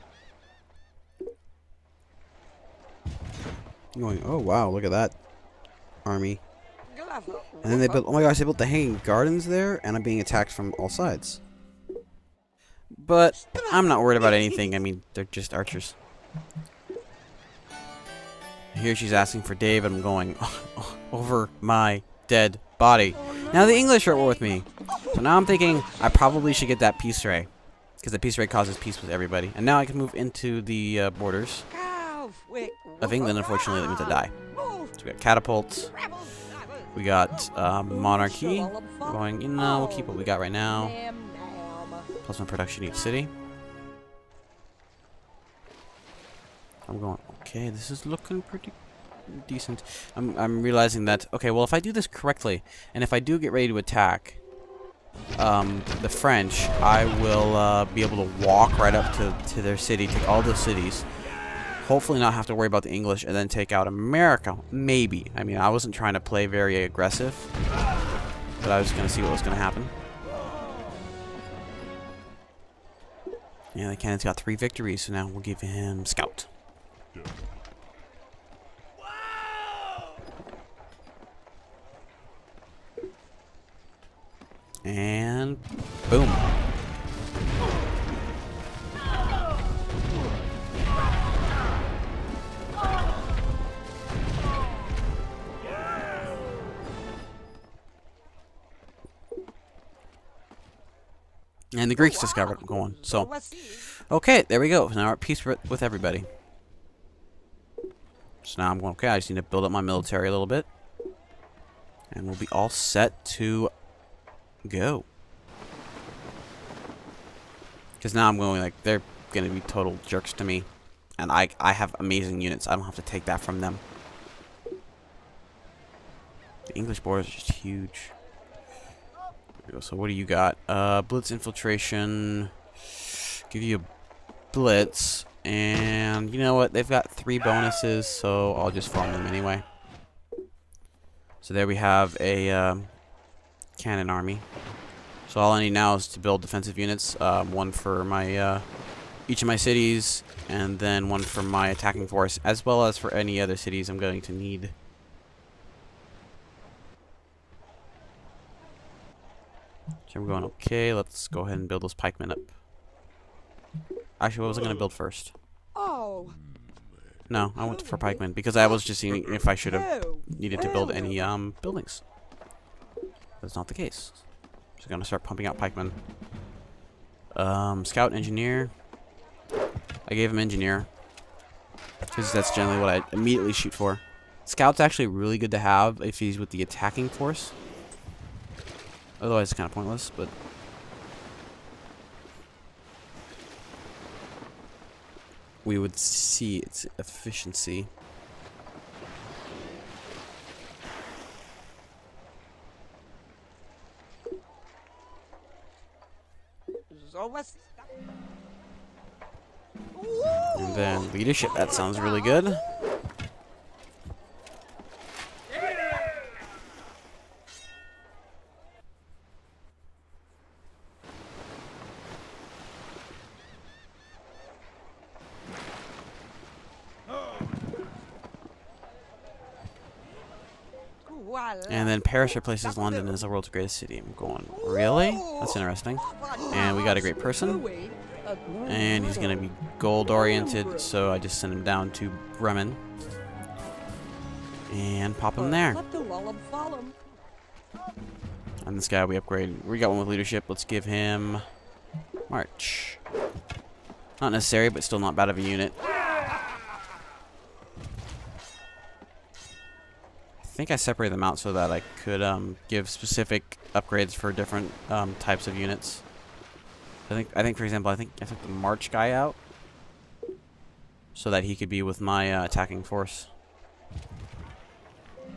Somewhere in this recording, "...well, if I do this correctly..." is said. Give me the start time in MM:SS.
00:51.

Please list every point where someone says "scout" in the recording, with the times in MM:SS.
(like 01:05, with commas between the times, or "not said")
01:16, 02:57, 03:04.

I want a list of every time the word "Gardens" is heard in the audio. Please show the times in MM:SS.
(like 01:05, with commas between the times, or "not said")
00:09.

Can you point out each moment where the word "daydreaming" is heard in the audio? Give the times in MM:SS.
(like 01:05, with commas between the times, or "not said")
not said.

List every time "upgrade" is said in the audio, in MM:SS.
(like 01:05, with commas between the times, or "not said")
04:09, 04:23.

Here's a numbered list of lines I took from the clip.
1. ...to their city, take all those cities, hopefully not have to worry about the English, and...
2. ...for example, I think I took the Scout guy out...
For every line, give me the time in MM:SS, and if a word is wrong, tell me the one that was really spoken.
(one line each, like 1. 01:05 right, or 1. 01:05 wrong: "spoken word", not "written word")
1. 00:59 right
2. 04:27 wrong: "March", not "Scout".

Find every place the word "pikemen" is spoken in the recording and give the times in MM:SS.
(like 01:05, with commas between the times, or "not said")
02:41, 02:47, 02:55.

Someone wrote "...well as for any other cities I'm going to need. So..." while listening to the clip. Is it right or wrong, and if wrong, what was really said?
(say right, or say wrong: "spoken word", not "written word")
right.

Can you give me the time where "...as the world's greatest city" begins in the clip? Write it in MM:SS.
03:53.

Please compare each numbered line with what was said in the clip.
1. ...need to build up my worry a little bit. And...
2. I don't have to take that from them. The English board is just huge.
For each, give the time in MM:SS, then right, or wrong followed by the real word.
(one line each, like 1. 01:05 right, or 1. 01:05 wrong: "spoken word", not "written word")
1. 01:49 wrong: "military", not "worry"
2. 02:02 right.